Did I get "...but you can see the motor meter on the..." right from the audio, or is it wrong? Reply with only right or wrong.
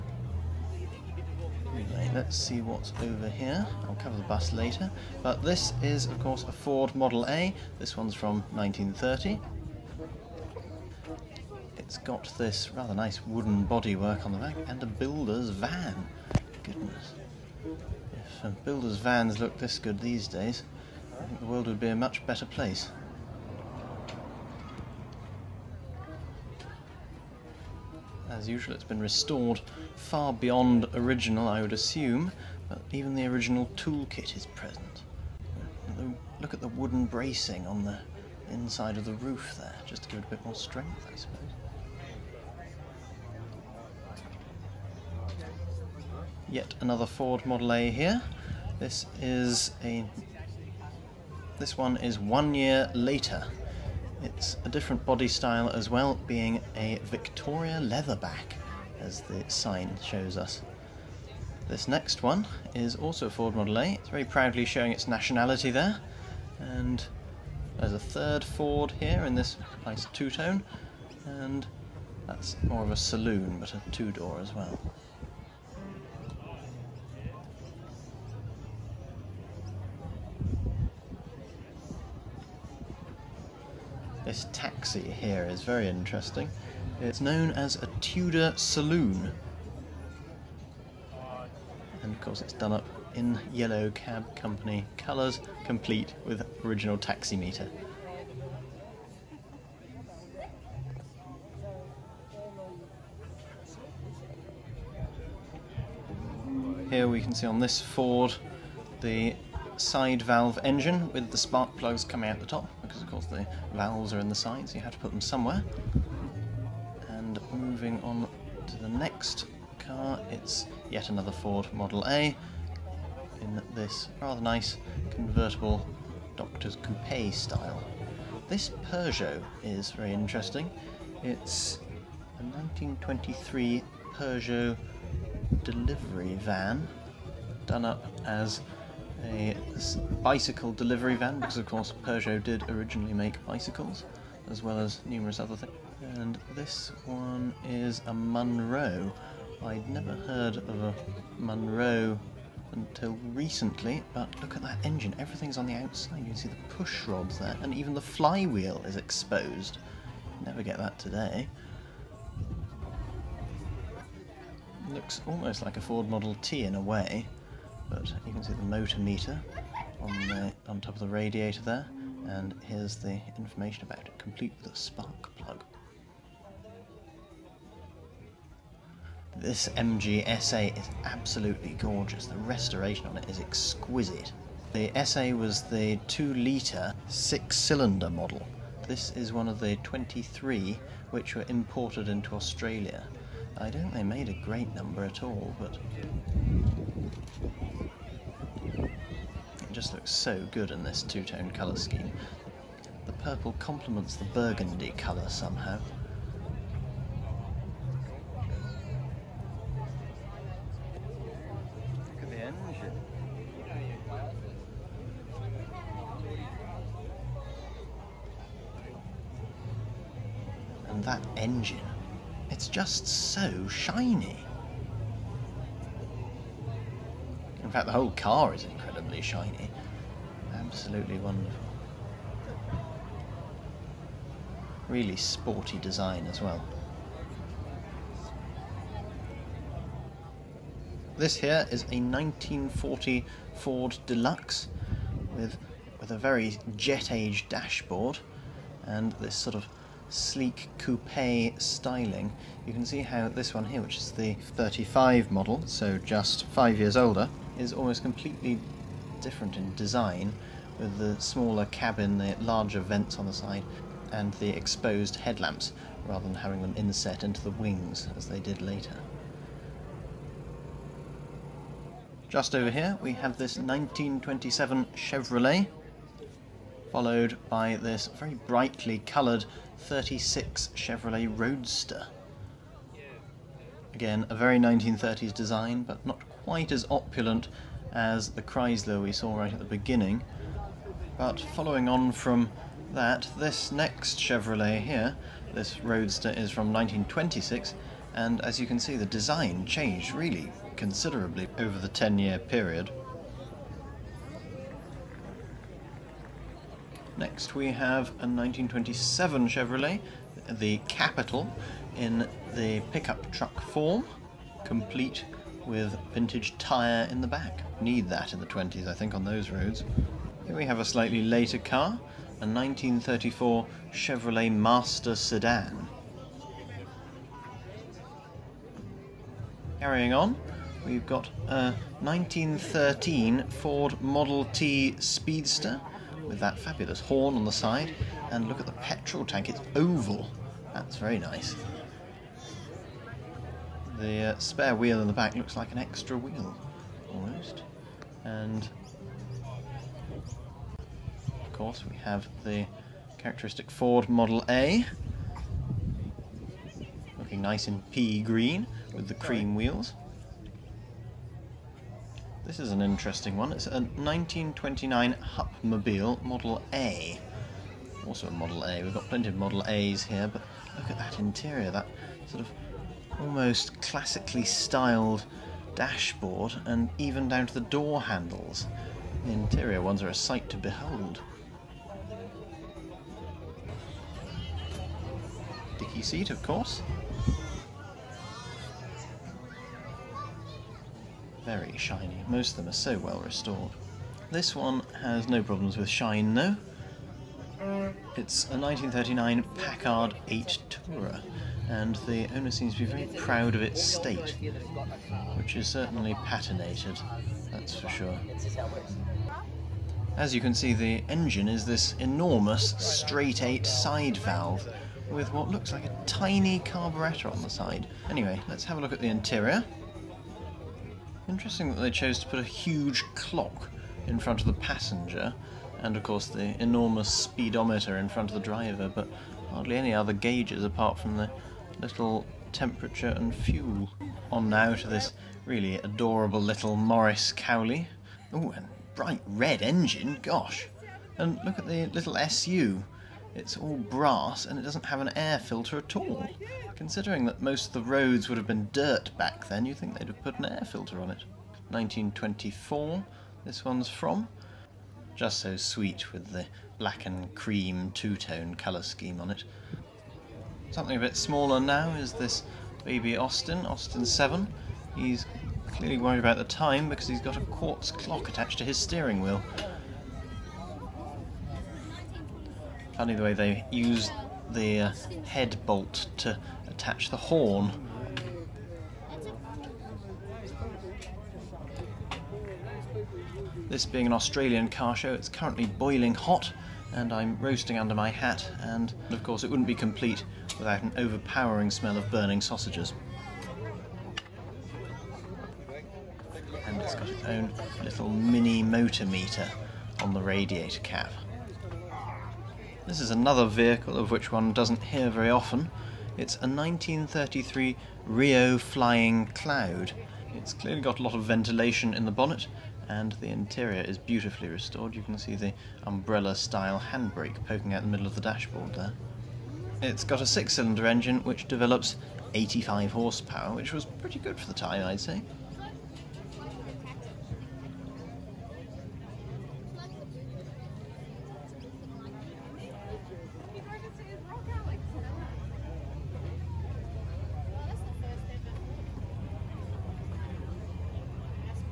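right.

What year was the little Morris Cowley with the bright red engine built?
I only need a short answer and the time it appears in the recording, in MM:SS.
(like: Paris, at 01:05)
1924, at 07:31.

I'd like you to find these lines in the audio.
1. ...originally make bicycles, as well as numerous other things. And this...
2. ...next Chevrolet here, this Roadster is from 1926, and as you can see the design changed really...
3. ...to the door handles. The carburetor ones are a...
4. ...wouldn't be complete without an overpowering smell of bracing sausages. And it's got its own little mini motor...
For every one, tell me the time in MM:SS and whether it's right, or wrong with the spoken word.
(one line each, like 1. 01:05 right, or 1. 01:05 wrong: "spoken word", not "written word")
1. 02:22 right
2. 04:53 right
3. 06:17 wrong: "interior", not "carburetor"
4. 08:09 wrong: "burning", not "bracing".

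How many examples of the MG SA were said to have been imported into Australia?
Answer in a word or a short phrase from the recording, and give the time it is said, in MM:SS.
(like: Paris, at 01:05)
23, at 03:09.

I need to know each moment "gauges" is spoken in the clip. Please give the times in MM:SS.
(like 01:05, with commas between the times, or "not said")
07:10.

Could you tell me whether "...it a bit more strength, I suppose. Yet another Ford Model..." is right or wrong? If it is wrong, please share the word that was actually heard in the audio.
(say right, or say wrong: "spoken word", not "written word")
right.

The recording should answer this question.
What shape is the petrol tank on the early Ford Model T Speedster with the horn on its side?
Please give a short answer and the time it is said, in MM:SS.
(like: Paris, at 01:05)
Oval, at 05:39.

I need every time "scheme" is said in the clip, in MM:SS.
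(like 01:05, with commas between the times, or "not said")
03:21, 07:38.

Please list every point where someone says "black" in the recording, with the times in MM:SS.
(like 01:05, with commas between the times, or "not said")
07:36.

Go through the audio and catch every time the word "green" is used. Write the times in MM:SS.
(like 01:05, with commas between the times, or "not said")
05:58.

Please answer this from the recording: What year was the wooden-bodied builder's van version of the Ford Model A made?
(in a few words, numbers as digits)
1930.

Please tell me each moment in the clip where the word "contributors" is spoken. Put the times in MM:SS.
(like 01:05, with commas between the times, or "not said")
not said.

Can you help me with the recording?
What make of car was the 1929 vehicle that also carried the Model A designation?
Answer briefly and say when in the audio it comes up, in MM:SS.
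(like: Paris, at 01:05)
Hupmobile, at 06:05.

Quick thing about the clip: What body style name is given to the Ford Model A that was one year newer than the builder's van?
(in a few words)
Victoria Leatherback.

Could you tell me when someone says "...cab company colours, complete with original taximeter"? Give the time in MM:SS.
01:33.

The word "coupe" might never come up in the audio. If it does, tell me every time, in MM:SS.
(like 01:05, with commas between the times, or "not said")
02:06, 04:10.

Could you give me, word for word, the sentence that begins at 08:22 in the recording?
This is another vehicle of which one doesn't hear very often.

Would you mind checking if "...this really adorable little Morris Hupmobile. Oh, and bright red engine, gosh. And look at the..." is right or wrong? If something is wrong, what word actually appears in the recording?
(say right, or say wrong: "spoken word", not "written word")
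wrong: "Cowley", not "Hupmobile".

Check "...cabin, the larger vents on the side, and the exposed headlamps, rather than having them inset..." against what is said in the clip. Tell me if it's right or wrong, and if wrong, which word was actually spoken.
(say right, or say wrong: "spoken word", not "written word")
right.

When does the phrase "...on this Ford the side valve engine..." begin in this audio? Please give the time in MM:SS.
01:47.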